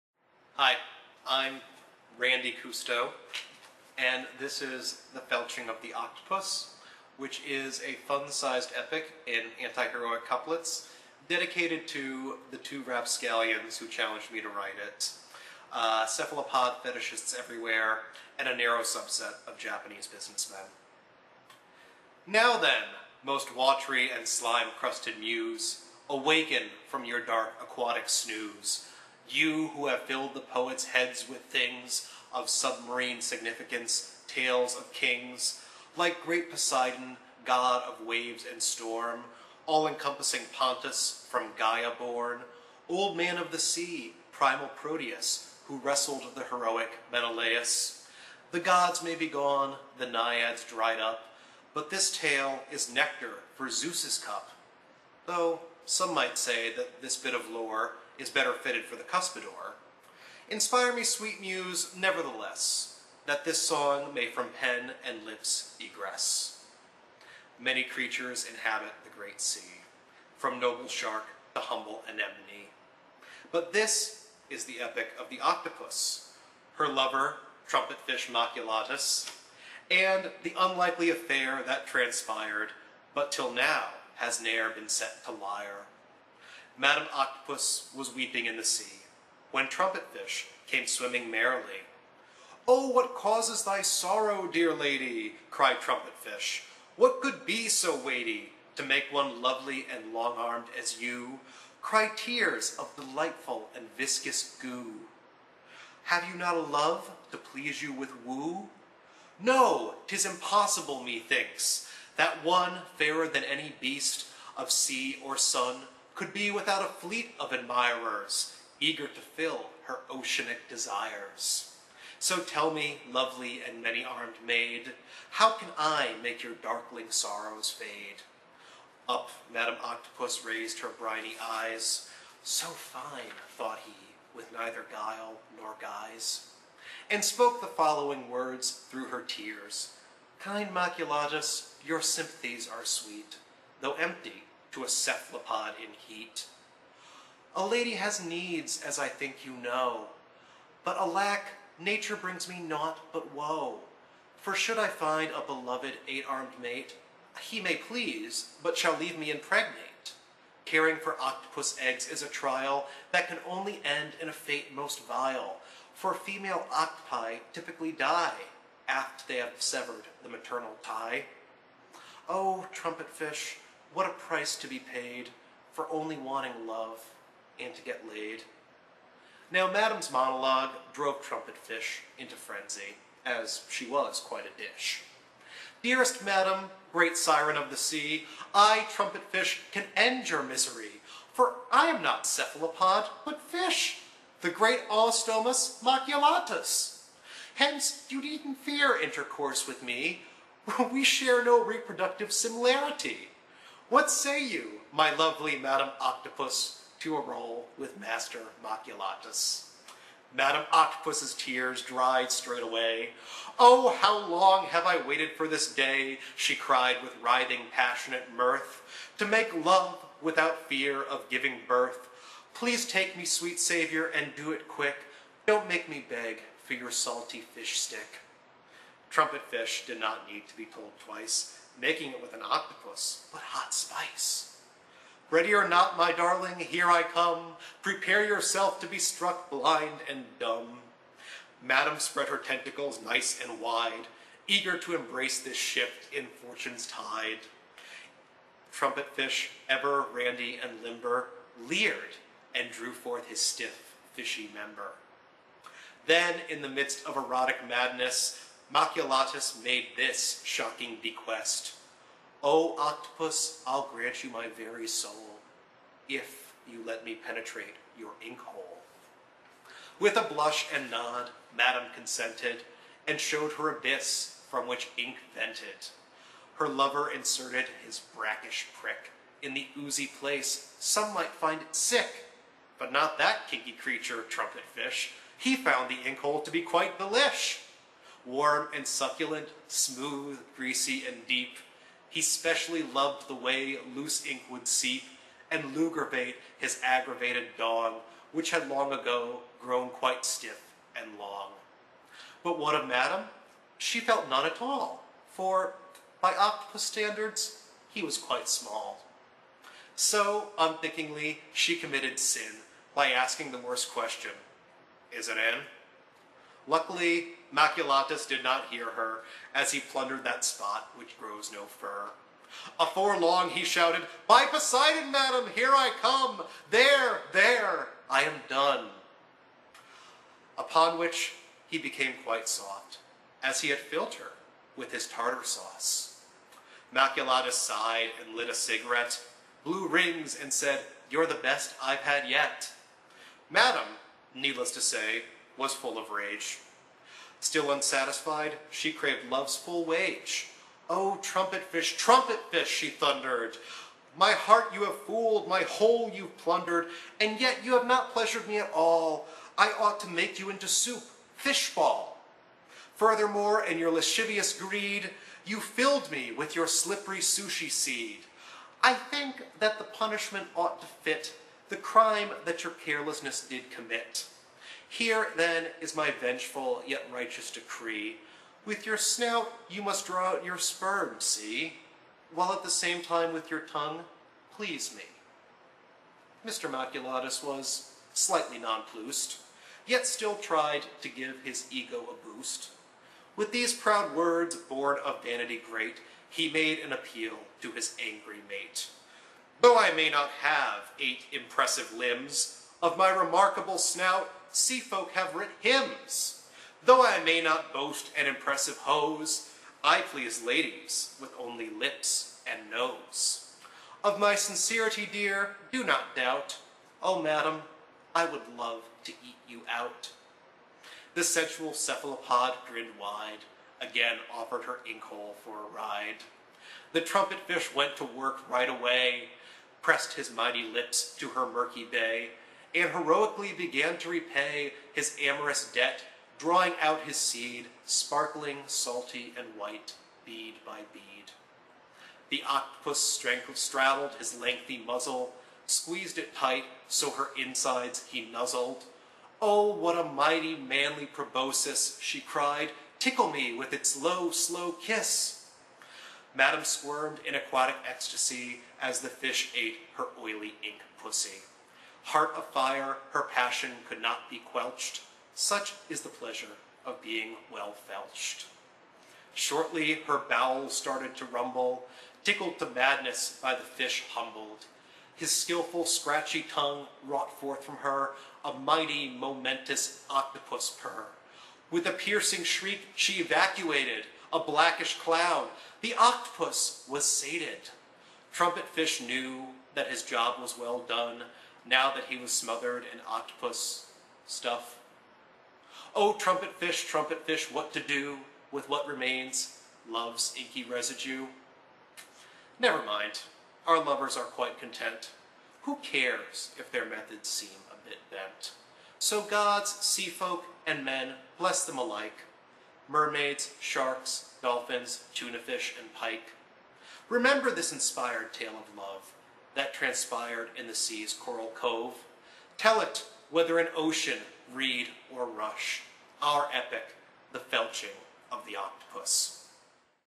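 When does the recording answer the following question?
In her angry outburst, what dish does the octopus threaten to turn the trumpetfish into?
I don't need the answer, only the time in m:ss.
6:00.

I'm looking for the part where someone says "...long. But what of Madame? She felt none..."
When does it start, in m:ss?
5:01.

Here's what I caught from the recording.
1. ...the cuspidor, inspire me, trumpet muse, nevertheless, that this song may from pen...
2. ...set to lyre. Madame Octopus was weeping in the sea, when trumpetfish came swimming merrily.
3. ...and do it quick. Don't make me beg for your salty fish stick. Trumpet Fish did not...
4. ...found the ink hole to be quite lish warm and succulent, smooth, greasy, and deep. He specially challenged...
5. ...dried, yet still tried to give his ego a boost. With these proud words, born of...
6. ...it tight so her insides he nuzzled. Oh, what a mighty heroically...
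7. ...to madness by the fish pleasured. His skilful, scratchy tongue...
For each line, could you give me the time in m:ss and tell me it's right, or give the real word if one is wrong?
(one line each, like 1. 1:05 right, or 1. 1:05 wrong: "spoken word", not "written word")
1. 0:58 wrong: "sweet", not "trumpet"
2. 1:24 right
3. 3:44 right
4. 4:45 wrong: "loved", not "challenged"
5. 6:28 wrong: "nonplussed", not "dried"
6. 7:26 wrong: "manly", not "heroically"
7. 7:52 wrong: "humbled", not "pleasured".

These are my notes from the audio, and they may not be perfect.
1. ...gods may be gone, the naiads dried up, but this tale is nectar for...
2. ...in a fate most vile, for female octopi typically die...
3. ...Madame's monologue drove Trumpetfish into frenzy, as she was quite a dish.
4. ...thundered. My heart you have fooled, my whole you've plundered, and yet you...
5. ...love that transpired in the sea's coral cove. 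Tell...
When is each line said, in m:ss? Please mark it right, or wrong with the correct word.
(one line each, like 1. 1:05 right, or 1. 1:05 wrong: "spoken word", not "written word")
1. 0:48 right
2. 2:44 right
3. 2:59 right
4. 5:52 right
5. 8:38 right.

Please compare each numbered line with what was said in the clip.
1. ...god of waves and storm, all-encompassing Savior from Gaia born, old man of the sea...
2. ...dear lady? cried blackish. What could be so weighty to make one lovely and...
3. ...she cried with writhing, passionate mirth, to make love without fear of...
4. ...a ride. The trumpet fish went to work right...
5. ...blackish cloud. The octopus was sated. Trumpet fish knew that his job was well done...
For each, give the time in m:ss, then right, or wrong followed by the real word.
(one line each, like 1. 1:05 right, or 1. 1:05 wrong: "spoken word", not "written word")
1. 0:37 wrong: "Pontus", not "Savior"
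2. 1:34 wrong: "trumpetfish", not "blackish"
3. 3:36 right
4. 7:05 right
5. 8:04 right.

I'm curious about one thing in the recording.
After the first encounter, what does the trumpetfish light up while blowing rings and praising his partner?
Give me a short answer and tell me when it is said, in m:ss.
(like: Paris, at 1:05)
A cigarette, at 5:38.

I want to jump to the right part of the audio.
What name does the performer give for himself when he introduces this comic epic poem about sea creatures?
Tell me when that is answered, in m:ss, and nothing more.
0:02.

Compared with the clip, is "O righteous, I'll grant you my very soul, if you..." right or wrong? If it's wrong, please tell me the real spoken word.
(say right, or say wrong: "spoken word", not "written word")
wrong: "octopus", not "righteous".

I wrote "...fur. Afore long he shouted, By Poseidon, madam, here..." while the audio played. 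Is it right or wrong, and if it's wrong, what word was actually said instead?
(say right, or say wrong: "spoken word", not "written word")
right.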